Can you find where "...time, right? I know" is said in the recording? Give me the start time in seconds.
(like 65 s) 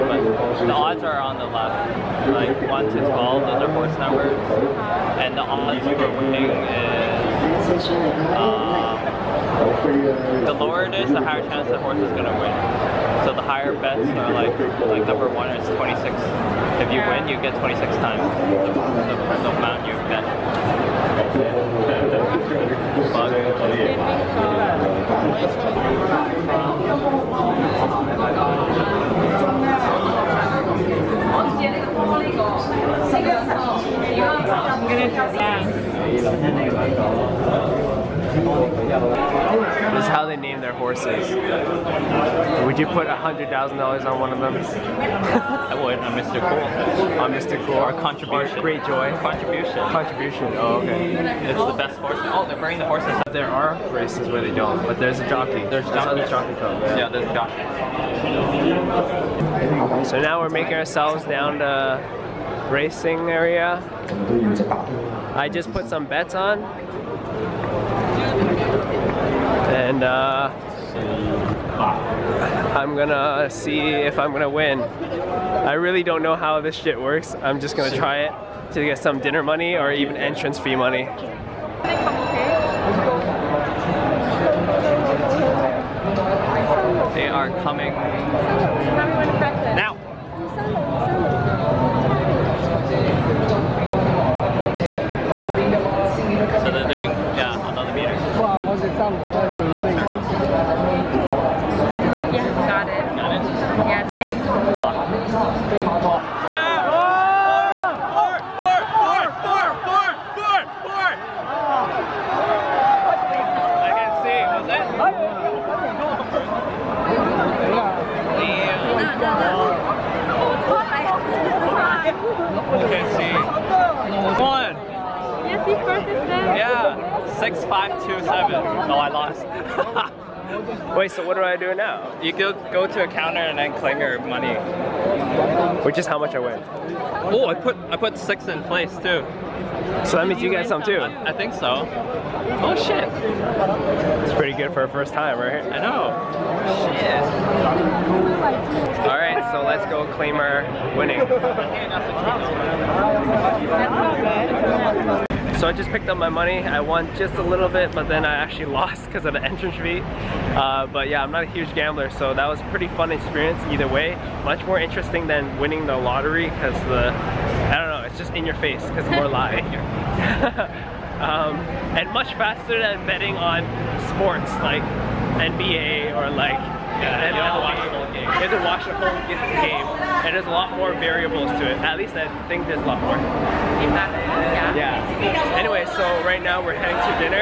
145 s.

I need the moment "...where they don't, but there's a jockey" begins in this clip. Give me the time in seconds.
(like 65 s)
54 s.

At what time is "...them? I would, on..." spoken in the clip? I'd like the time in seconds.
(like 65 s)
44 s.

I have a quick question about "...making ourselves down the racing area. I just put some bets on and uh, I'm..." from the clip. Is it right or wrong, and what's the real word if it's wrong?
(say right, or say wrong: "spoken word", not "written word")
right.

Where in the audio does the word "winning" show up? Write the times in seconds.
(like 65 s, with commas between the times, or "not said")
6 s, 150 s, 165 s.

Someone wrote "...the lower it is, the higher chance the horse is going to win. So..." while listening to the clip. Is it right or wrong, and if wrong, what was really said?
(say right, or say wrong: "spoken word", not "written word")
right.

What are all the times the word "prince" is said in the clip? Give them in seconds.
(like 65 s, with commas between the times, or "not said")
not said.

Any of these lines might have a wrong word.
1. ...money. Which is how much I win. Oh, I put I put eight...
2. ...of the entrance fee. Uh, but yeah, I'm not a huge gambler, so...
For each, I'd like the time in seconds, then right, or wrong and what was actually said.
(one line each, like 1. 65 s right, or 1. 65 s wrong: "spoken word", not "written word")
1. 134 s wrong: "six", not "eight"
2. 159 s right.